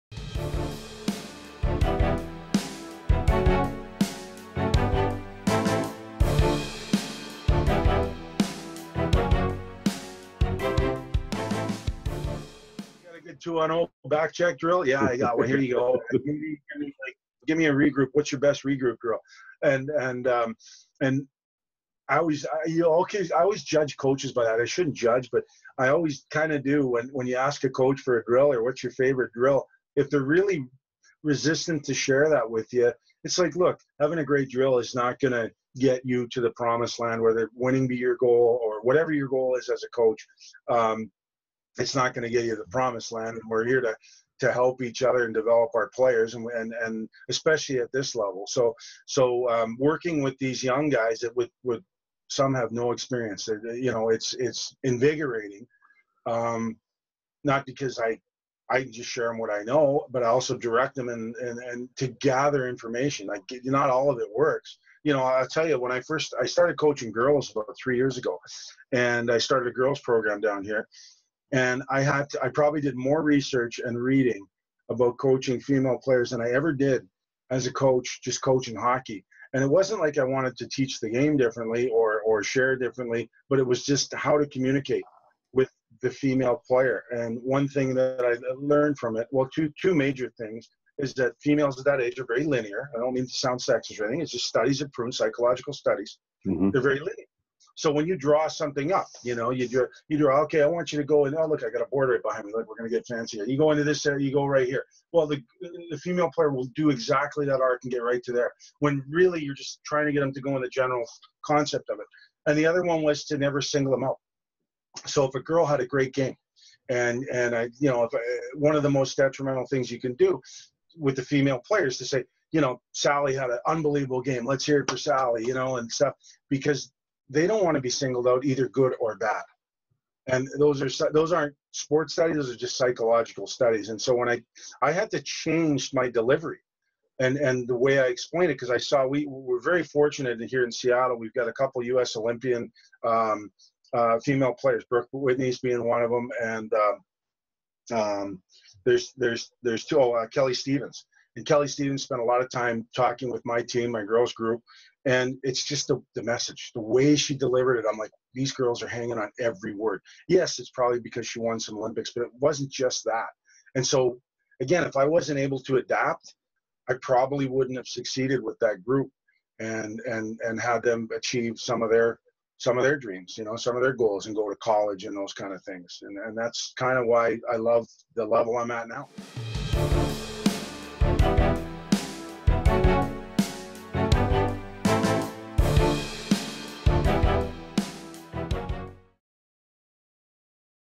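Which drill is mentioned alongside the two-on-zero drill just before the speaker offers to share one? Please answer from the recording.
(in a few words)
Back check.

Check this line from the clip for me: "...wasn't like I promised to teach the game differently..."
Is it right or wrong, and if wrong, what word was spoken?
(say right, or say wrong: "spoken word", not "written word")
wrong: "wanted", not "promised".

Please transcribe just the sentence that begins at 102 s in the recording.
Look, we're going to get fancy You go into this area, uh, you go right here.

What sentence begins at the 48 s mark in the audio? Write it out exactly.
So so um, working with these young guys that with would some have no experience.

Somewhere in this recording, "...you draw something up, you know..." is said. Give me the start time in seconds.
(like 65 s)
98 s.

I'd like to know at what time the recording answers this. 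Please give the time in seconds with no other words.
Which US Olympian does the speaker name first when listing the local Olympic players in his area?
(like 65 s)
144 s.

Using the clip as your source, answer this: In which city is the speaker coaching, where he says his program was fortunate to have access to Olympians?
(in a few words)
Seattle.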